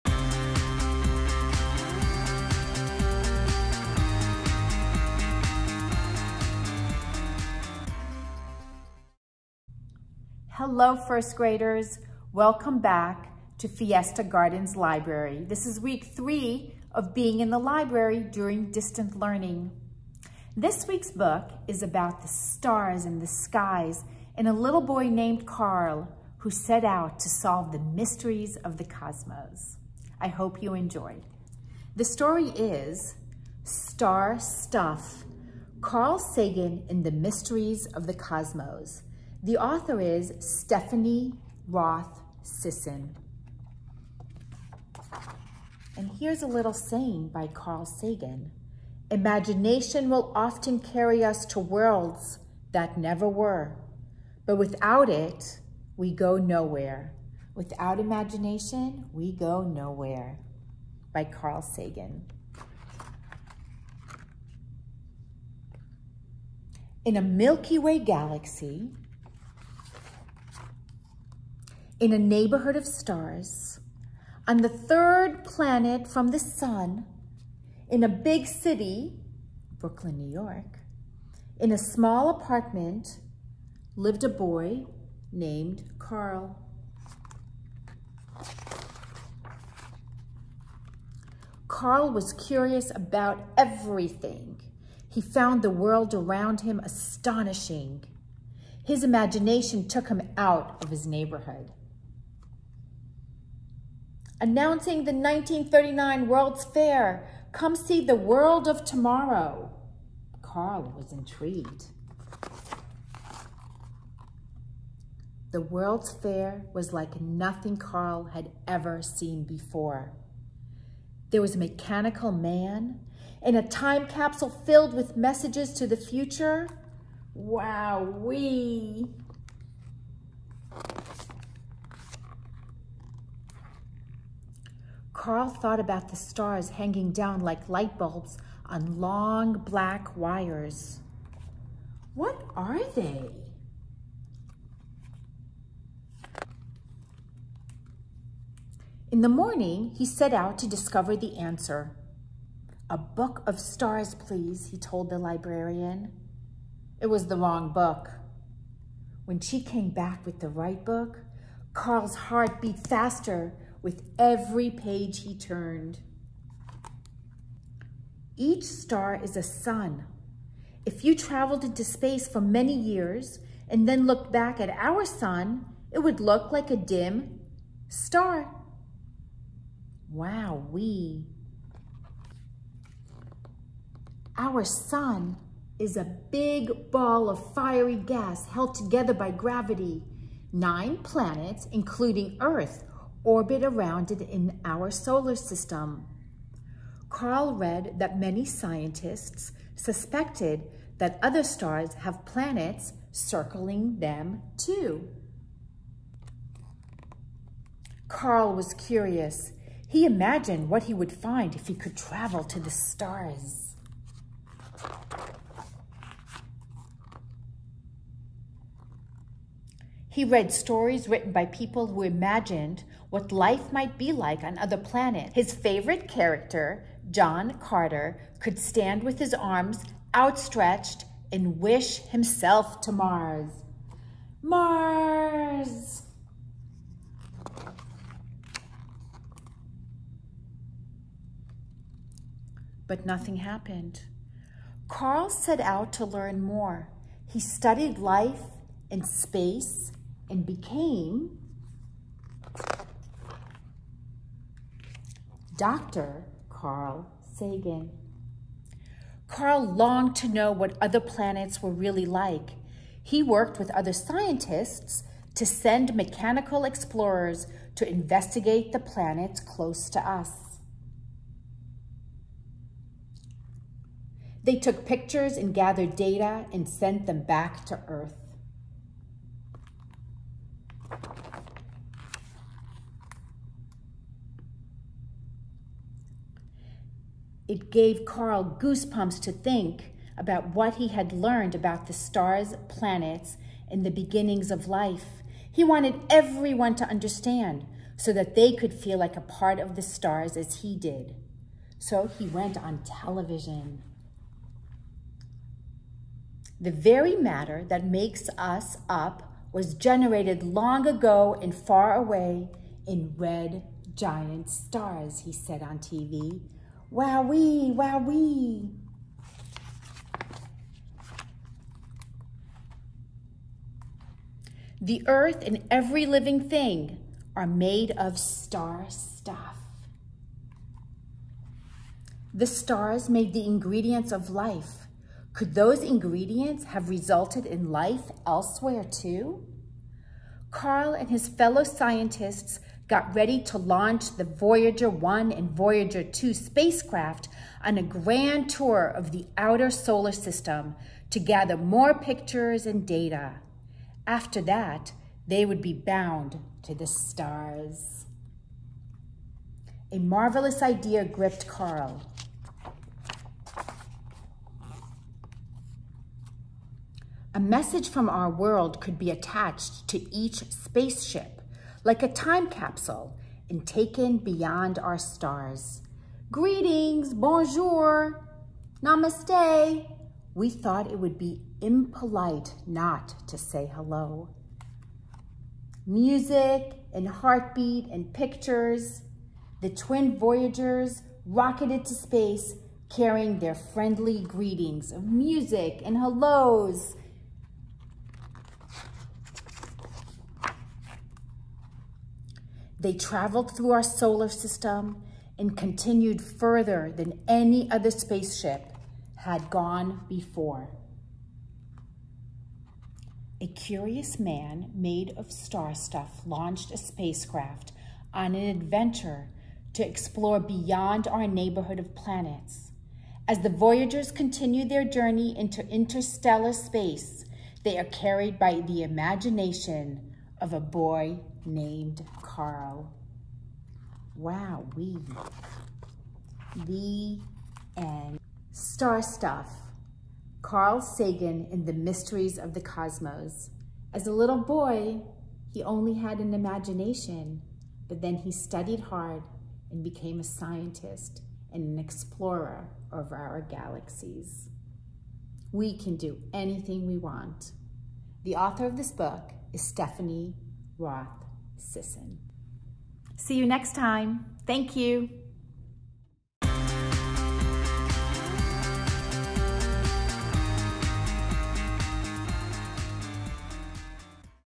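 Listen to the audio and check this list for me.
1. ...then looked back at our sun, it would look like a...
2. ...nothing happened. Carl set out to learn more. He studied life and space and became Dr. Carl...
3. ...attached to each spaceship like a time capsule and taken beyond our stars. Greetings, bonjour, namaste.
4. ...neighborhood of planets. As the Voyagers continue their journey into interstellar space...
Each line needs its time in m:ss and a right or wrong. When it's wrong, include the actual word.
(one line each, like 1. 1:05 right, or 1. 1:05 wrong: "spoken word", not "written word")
1. 2:53 right
2. 4:03 right
3. 6:09 right
4. 7:01 right.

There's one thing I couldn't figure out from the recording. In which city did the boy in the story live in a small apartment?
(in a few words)
Brooklyn, New York.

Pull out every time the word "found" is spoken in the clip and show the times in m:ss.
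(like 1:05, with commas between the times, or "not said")
1:35.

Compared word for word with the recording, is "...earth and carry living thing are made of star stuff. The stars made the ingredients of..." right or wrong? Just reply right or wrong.
wrong.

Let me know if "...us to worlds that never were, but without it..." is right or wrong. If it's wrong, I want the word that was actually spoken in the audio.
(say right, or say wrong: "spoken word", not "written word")
right.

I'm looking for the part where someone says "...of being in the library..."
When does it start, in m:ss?
0:16.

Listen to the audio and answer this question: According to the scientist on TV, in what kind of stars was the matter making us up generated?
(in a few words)
red giant stars.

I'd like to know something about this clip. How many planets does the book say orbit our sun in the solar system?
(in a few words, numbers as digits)
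9.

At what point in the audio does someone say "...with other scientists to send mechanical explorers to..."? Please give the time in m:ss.
4:23.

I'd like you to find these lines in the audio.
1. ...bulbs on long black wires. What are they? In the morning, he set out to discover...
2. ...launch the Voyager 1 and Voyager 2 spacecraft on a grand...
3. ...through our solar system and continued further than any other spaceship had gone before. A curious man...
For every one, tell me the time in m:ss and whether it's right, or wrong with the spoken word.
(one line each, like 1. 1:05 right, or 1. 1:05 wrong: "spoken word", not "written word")
1. 2:17 right
2. 5:43 right
3. 6:43 right.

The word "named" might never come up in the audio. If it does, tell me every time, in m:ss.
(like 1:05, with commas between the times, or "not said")
0:25, 1:25, 7:11.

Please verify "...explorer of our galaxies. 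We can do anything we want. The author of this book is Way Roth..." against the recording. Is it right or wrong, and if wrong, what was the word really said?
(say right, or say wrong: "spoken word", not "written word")
wrong: "Stephanie", not "Way".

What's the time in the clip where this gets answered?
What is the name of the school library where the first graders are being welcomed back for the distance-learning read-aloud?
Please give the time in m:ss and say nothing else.
0:13.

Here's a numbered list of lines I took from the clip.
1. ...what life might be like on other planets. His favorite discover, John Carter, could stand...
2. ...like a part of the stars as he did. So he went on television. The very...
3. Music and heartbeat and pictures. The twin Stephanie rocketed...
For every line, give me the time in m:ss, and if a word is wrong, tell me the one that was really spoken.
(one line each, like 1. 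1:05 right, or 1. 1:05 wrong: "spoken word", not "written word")
1. 3:43 wrong: "character", not "discover"
2. 4:58 right
3. 6:25 wrong: "Voyagers", not "Stephanie".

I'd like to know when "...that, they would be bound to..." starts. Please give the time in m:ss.
5:54.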